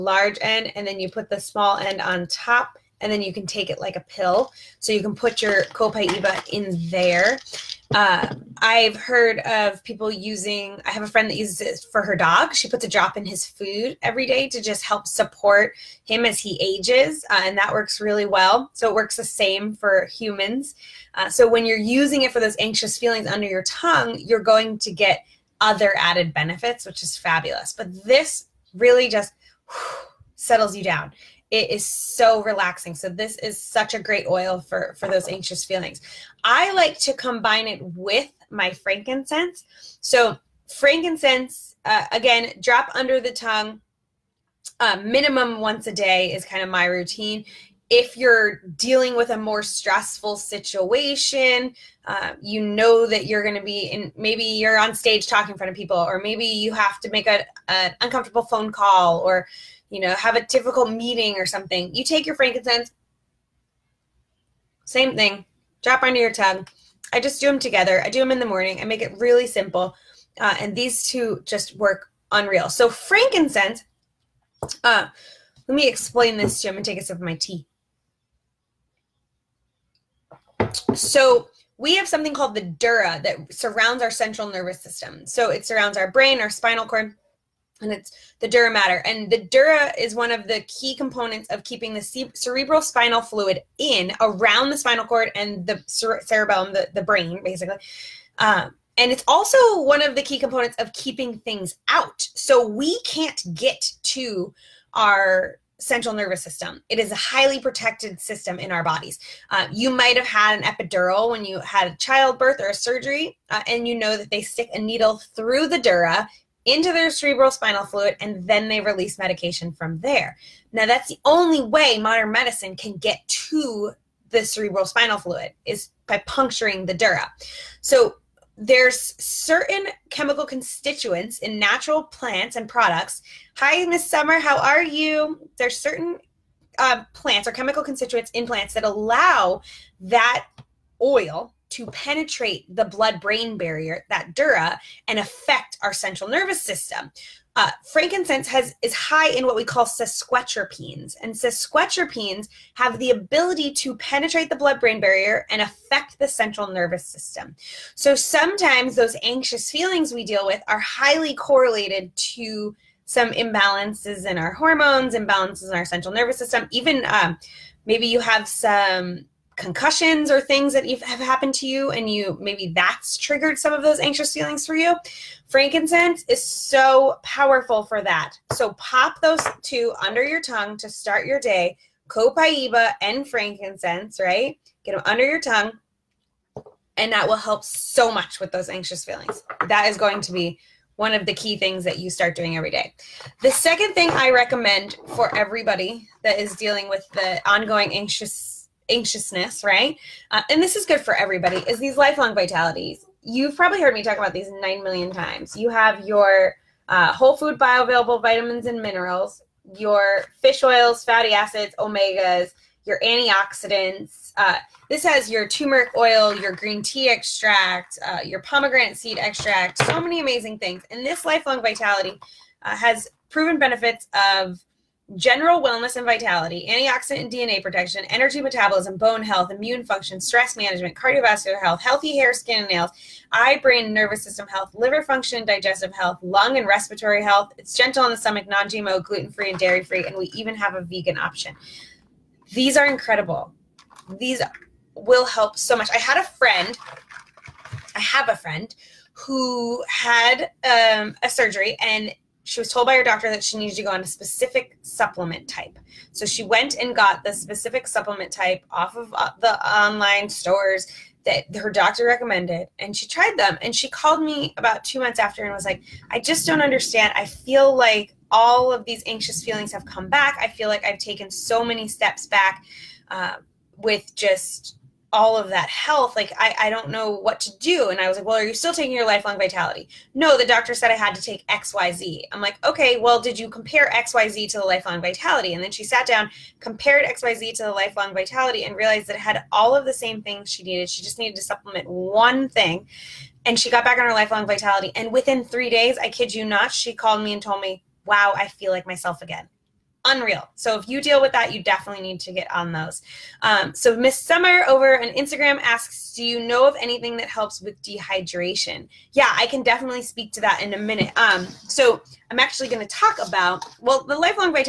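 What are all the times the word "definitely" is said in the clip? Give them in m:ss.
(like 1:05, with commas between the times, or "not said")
5:01, 5:09.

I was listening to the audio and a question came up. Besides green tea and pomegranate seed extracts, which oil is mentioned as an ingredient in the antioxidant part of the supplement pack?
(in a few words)
Turmeric oil.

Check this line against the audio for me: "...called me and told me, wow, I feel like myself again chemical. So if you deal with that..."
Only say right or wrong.
wrong.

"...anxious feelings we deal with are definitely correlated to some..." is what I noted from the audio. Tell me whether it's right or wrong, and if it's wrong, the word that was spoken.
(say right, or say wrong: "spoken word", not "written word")
wrong: "highly", not "definitely".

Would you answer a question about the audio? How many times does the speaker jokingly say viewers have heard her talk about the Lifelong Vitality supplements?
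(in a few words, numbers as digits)
9 million.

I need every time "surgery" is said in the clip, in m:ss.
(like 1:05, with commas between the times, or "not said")
1:52, 4:11.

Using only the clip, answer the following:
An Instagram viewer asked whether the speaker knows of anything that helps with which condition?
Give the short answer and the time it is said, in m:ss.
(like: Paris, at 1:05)
Dehydration, at 5:07.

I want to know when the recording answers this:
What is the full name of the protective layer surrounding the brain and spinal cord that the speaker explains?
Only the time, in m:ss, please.
1:28.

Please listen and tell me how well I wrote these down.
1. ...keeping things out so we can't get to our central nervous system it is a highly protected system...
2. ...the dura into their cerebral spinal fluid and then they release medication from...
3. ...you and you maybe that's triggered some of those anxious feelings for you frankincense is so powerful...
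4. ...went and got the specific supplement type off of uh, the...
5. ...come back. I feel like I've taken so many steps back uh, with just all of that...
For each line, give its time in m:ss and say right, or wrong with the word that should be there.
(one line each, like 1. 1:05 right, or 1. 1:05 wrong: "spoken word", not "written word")
1. 1:40 right
2. 1:55 right
3. 2:51 right
4. 4:16 right
5. 4:29 right.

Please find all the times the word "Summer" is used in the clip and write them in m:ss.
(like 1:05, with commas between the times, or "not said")
2:14, 5:04.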